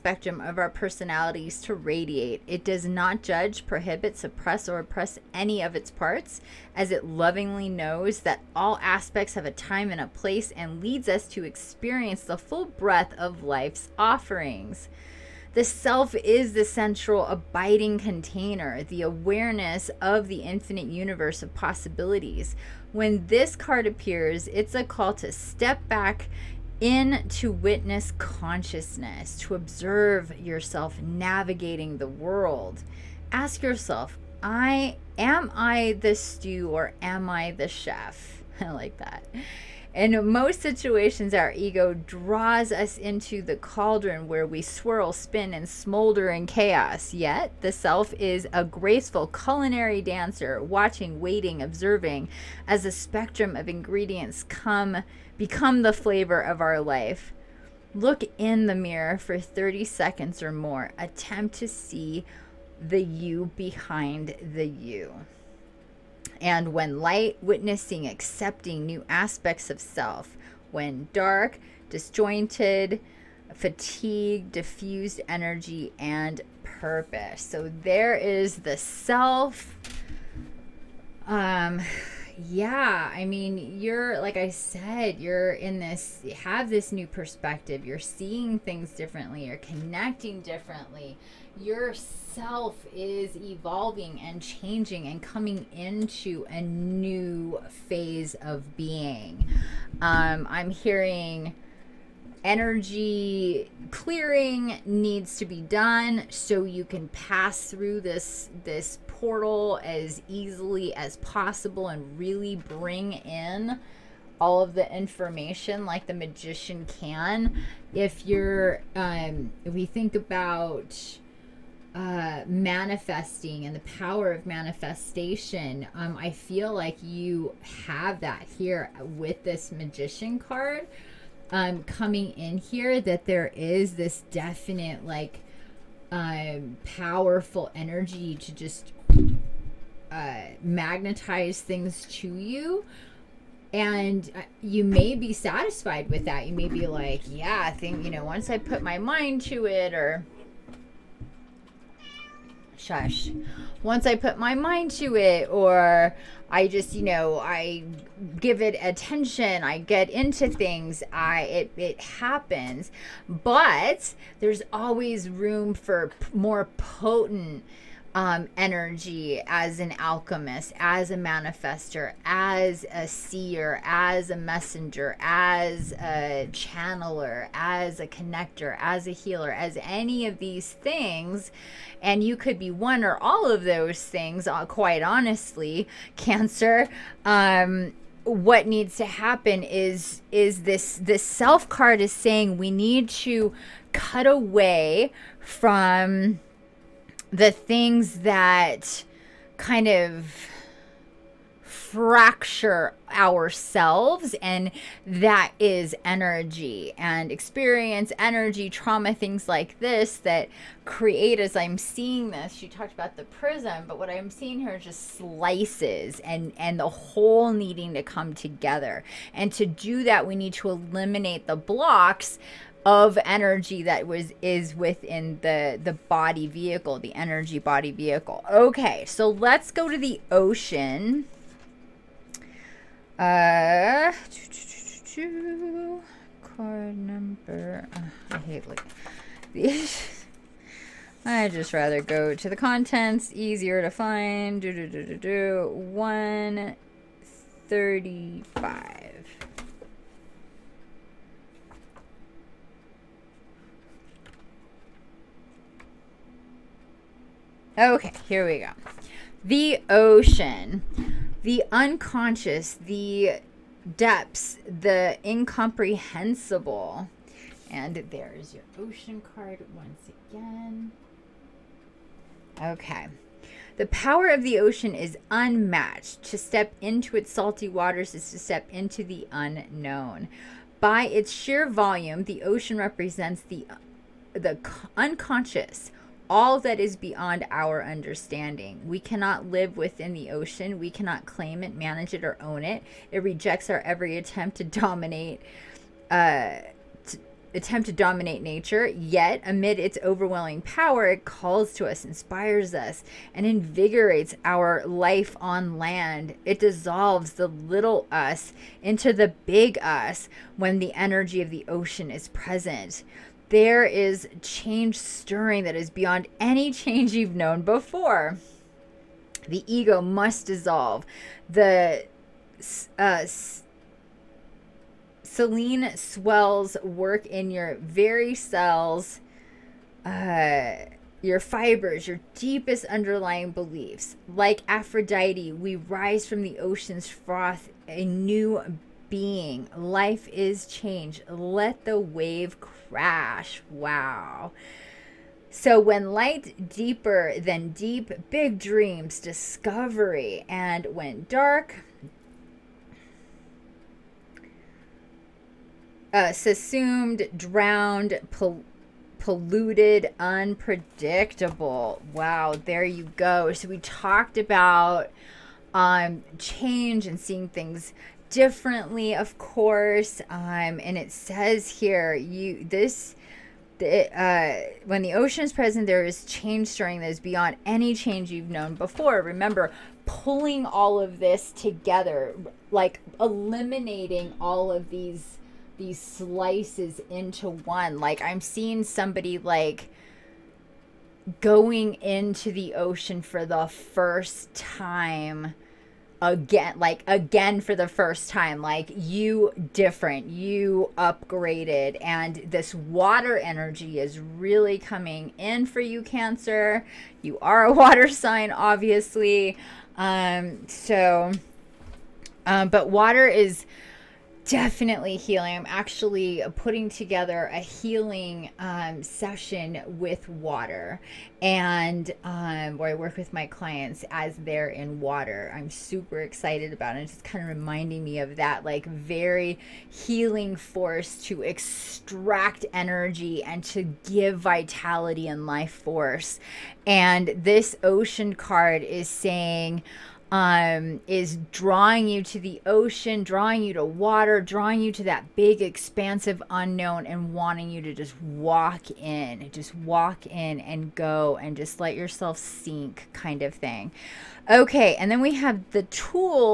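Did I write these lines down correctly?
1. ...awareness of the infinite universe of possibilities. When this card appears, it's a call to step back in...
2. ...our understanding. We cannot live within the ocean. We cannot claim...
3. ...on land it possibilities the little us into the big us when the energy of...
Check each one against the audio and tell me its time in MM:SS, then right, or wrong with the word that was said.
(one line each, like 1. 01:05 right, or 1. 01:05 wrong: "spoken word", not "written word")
1. 00:19 right
2. 04:47 right
3. 05:05 wrong: "dissolves", not "possibilities".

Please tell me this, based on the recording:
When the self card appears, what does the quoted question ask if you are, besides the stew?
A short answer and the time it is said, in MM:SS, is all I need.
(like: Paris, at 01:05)
The chef, at 00:37.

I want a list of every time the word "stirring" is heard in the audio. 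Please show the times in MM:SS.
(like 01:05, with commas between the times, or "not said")
05:14, 06:16.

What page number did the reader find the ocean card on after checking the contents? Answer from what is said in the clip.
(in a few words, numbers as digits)
135.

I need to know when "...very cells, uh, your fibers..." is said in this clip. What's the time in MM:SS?
05:27.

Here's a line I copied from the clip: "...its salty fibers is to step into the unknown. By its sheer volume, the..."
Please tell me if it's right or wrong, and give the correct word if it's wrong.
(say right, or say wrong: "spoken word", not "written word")
wrong: "waters", not "fibers".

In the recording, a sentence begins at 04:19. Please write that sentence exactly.
The ocean, the unconscious, the depths, the incomprehensible.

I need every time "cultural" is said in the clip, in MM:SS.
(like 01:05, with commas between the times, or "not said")
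not said.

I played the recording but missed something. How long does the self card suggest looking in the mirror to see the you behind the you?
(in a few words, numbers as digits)
30 seconds.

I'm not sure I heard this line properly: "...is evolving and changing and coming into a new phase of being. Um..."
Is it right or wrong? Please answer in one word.
right.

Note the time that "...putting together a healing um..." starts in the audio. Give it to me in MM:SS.
06:56.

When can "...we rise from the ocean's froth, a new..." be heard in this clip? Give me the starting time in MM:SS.
05:35.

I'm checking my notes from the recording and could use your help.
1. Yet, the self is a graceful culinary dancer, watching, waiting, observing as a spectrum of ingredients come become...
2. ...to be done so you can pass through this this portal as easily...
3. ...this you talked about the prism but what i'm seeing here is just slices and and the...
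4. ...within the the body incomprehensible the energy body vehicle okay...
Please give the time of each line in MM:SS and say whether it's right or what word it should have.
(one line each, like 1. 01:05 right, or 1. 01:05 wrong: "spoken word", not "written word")
1. 00:47 right
2. 01:45 right
3. 03:32 right
4. 03:44 wrong: "vehicle", not "incomprehensible".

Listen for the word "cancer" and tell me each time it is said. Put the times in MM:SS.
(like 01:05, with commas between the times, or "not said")
03:06, 06:46.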